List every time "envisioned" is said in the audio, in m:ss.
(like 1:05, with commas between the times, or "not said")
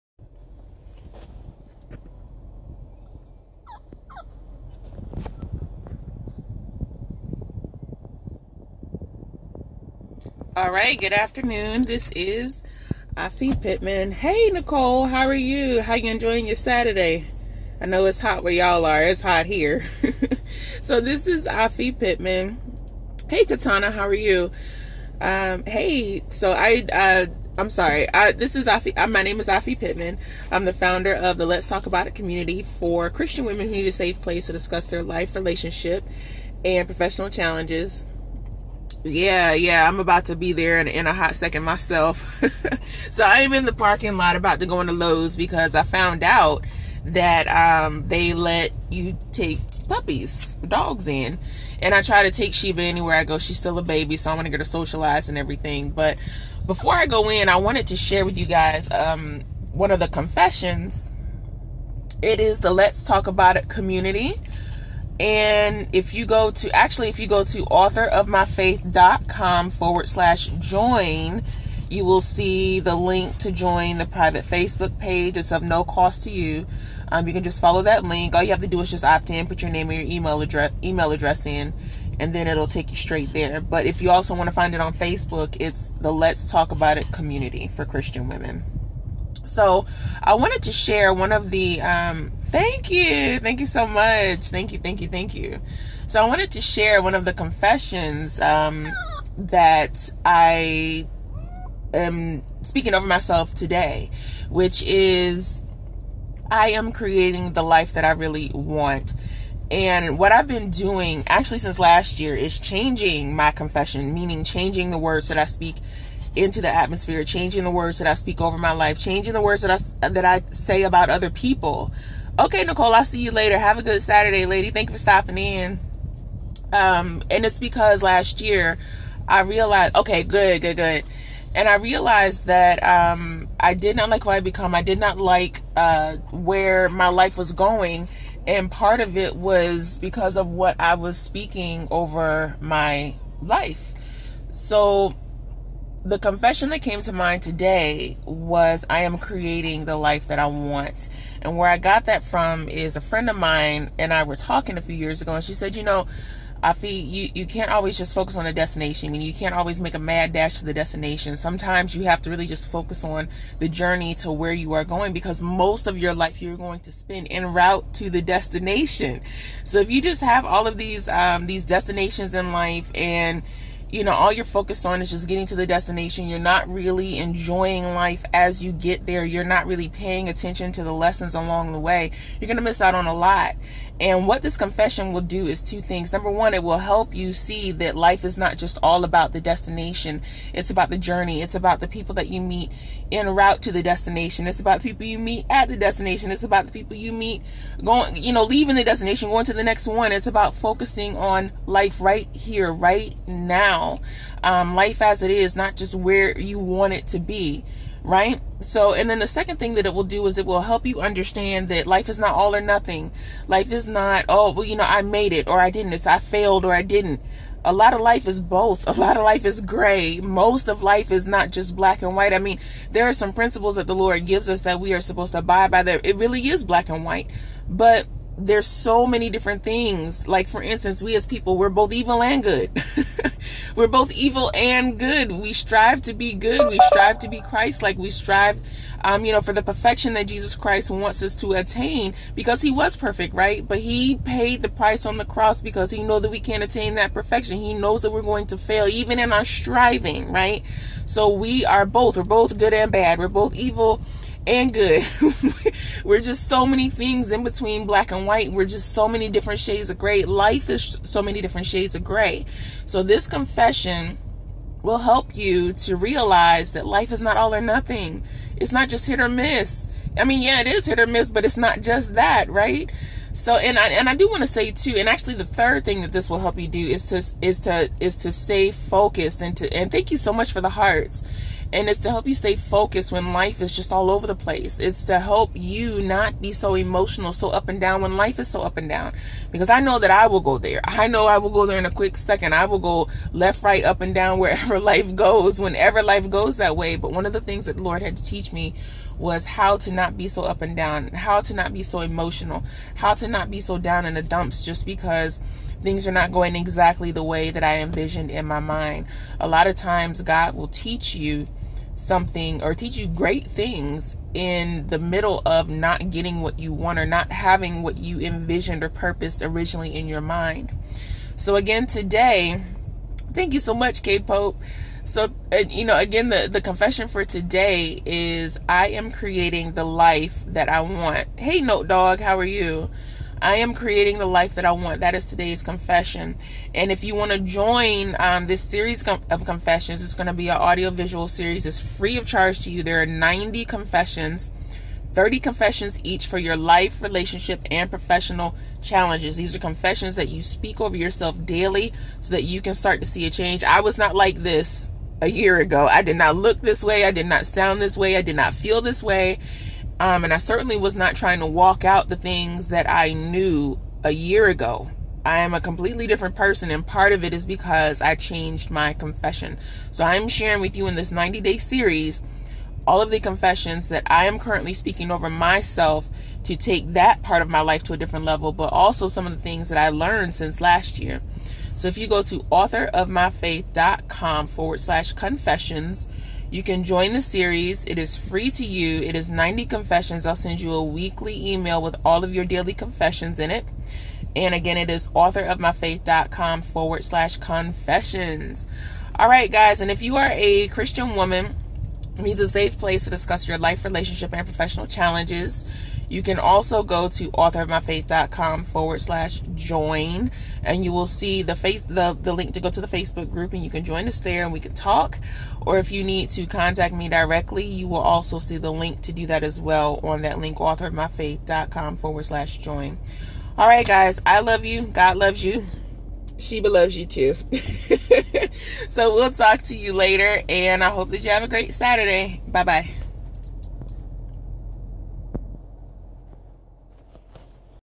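5:07, 5:18.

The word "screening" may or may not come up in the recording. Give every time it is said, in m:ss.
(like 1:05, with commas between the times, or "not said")
not said.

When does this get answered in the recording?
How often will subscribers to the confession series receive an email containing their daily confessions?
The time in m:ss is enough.
6:30.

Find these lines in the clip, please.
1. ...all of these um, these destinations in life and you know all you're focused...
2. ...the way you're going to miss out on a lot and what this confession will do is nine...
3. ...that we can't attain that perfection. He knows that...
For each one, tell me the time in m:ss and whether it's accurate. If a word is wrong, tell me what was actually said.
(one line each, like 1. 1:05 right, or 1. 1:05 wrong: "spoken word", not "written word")
1. 2:50 right
2. 3:01 wrong: "two", not "nine"
3. 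4:06 right.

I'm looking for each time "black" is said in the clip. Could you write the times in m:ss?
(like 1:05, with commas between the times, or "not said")
3:41, 3:46, 4:17.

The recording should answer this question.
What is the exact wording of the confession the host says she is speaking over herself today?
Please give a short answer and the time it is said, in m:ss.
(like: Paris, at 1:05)
I am creating the life that I really want, at 1:46.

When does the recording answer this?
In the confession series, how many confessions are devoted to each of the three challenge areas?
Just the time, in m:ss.
5:45.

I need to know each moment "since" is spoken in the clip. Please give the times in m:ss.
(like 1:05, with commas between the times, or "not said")
1:51, 6:20.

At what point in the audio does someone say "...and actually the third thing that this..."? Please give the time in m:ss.
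4:34.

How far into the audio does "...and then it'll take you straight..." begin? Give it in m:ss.
1:22.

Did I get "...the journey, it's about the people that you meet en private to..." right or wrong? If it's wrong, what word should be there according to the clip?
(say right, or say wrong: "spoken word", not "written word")
wrong: "route", not "private".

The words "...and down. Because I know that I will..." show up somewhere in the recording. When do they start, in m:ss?
4:48.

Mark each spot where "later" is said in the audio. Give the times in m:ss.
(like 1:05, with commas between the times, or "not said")
2:03, 7:09.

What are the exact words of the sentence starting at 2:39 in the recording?
I mean, you can't always make a mad dash to the destination.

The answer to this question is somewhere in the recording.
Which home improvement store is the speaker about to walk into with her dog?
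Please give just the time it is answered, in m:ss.
0:44.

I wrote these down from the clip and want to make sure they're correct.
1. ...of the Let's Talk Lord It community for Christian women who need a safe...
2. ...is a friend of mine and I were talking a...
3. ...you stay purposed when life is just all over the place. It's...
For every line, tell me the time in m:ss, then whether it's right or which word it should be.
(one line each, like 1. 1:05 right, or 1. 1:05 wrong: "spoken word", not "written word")
1. 0:31 wrong: "About", not "Lord"
2. 2:32 right
3. 4:42 wrong: "focused", not "purposed".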